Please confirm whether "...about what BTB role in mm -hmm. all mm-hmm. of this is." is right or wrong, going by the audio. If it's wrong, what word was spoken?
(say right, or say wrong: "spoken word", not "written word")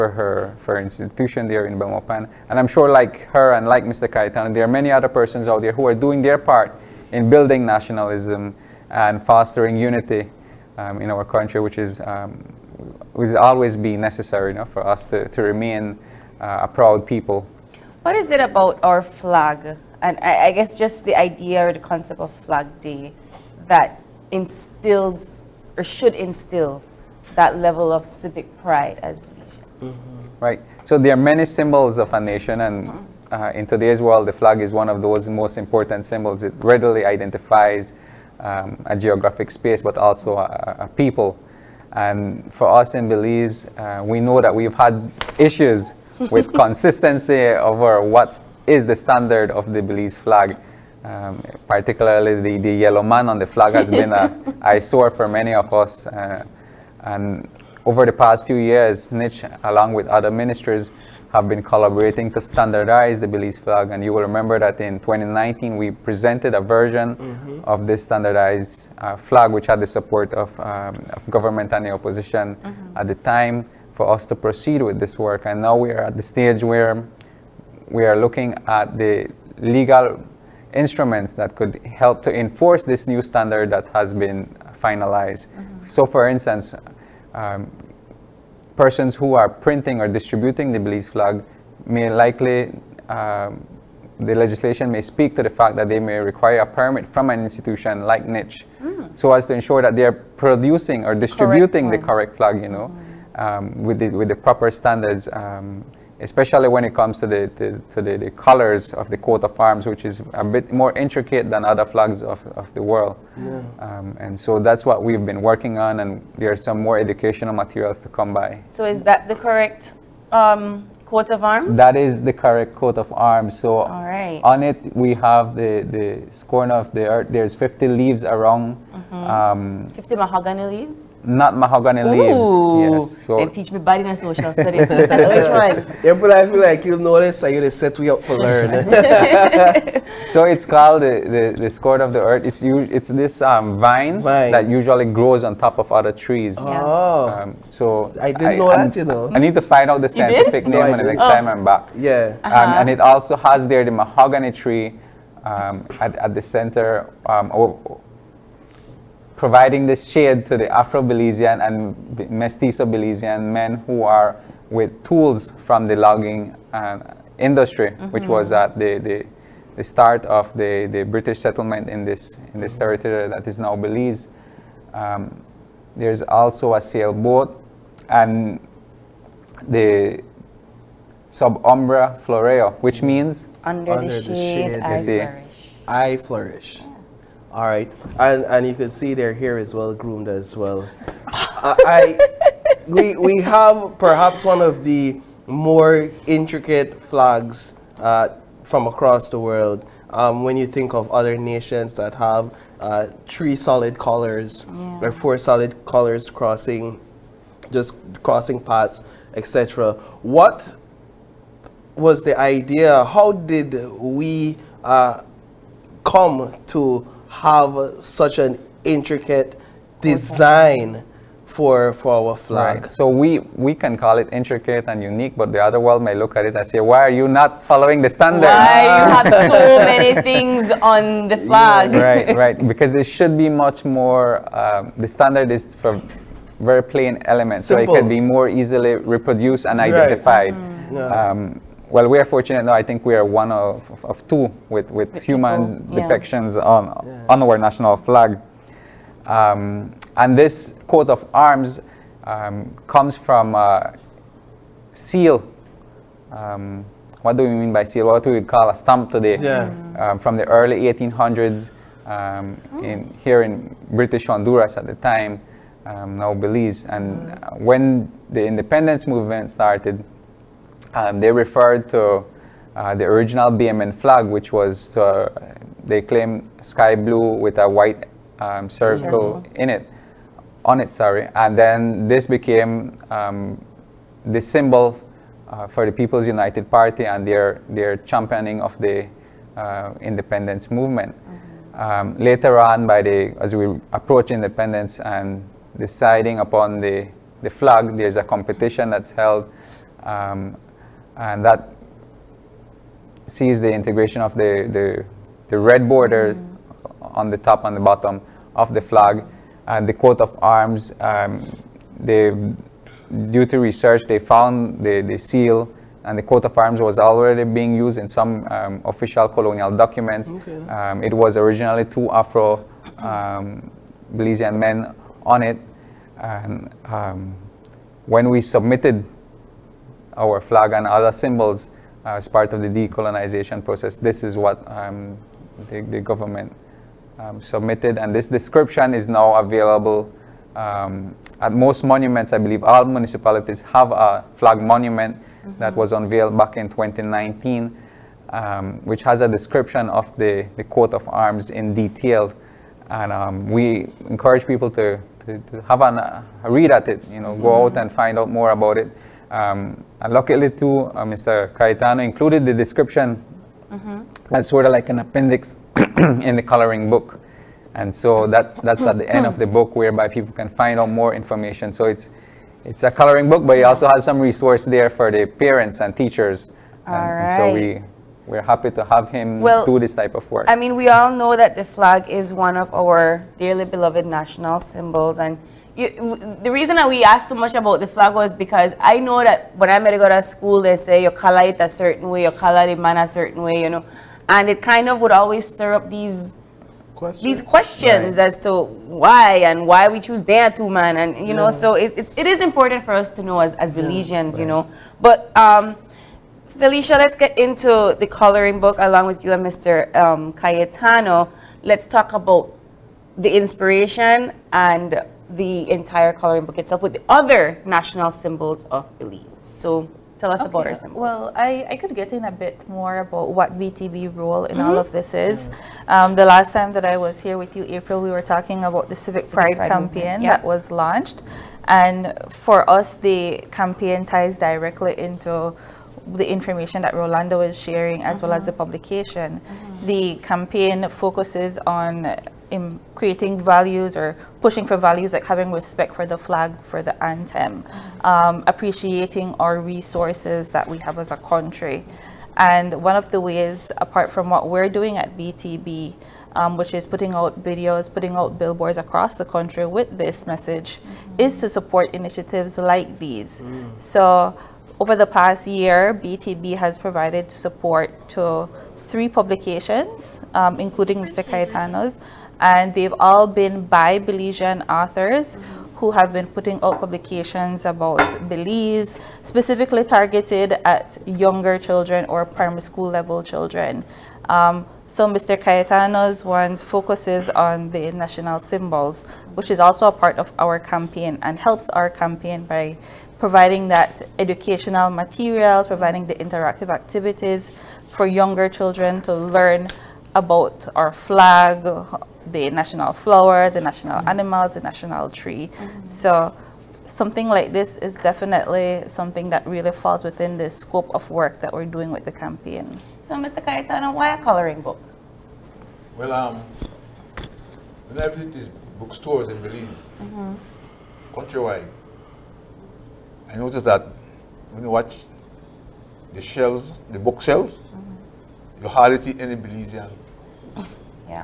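right.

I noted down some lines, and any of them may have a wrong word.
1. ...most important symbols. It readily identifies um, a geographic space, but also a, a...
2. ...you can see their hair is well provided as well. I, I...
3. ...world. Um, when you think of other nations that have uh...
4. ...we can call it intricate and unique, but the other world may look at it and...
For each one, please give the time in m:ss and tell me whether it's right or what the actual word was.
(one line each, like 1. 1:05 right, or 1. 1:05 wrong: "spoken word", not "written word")
1. 0:35 right
2. 3:08 wrong: "groomed", not "provided"
3. 3:19 right
4. 3:43 right.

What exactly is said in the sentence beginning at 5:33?
This is what um, the, the, government um, submitted, and this description is now available um, at most monuments.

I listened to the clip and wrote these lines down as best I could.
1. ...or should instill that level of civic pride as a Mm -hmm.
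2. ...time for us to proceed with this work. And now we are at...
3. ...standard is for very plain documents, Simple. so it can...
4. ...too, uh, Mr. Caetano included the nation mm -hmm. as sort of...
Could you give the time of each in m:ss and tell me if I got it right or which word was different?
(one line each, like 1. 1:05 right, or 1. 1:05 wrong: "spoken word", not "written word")
1. 0:25 right
2. 1:13 right
3. 3:55 wrong: "elements", not "documents"
4. 6:00 wrong: "description", not "nation".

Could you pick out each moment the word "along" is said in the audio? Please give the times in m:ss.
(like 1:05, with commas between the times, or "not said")
0:59, 6:48.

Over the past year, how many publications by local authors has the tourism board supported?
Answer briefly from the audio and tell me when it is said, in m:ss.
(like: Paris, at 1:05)
3, at 7:48.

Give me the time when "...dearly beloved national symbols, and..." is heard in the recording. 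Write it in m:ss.
6:23.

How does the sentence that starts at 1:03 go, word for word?
And you will remember that in 2019, we presented a version mm -hmm.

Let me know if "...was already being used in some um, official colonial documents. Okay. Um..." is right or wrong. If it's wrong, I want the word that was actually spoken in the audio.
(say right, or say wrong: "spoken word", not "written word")
right.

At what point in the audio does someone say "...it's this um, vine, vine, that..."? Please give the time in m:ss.
2:22.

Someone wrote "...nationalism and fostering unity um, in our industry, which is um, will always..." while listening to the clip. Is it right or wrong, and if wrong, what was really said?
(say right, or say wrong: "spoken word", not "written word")
wrong: "country", not "industry".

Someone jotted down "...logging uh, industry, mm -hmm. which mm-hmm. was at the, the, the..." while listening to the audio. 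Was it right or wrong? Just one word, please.
right.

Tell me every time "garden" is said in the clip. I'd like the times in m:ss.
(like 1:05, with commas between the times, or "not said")
not said.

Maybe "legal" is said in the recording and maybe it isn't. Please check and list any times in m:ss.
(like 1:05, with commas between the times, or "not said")
1:19.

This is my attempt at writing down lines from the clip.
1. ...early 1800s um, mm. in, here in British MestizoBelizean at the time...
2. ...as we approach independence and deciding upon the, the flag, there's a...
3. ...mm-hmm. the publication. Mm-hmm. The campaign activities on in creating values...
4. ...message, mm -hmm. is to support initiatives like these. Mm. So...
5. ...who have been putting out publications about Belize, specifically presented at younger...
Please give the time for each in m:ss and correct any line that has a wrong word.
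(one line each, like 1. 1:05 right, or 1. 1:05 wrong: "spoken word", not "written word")
1. 4:20 wrong: "Honduras", not "MestizoBelizean"
2. 4:53 right
3. 7:18 wrong: "focuses", not "activities"
4. 7:40 right
5. 7:55 wrong: "targeted", not "presented".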